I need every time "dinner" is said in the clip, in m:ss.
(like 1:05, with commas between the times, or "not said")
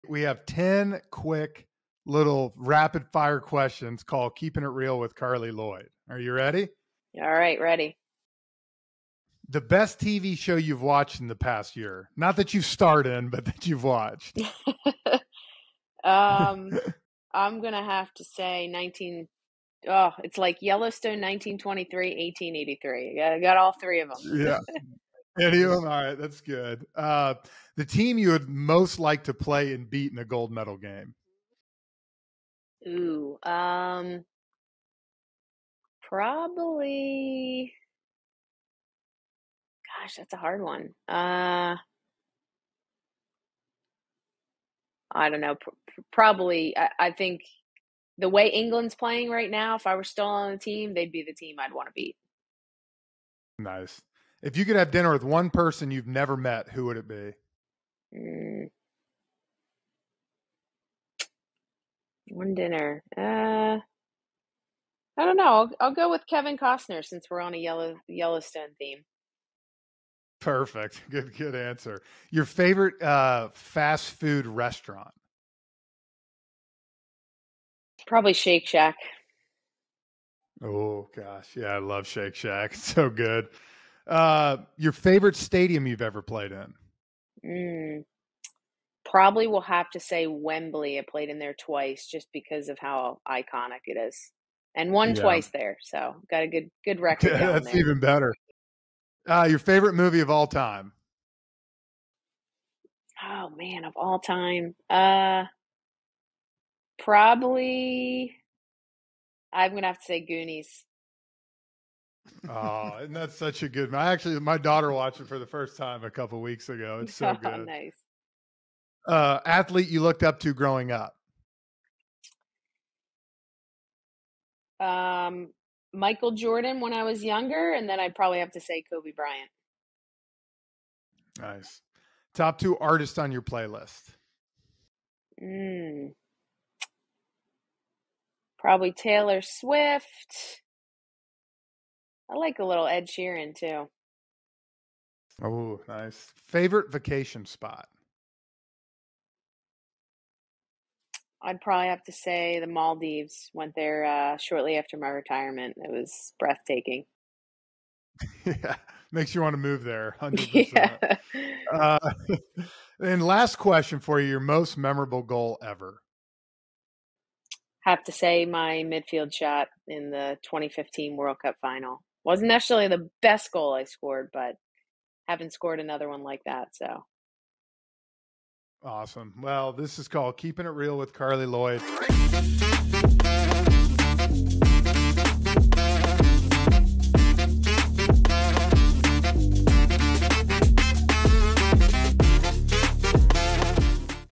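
0:54, 1:02.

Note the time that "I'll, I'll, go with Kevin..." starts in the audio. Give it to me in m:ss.
1:05.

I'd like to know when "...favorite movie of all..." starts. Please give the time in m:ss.
1:39.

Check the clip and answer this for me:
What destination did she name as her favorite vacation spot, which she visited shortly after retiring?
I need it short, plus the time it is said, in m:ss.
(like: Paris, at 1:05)
the Maldives, at 2:32.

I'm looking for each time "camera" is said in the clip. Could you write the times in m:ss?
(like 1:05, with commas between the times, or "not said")
not said.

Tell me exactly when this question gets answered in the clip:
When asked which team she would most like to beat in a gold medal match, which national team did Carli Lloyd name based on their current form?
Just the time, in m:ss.
0:48.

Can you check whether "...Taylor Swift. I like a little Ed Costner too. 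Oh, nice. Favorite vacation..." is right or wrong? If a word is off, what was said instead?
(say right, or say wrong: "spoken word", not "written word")
wrong: "Sheeran", not "Costner".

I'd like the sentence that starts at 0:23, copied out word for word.
I got, got all three of them.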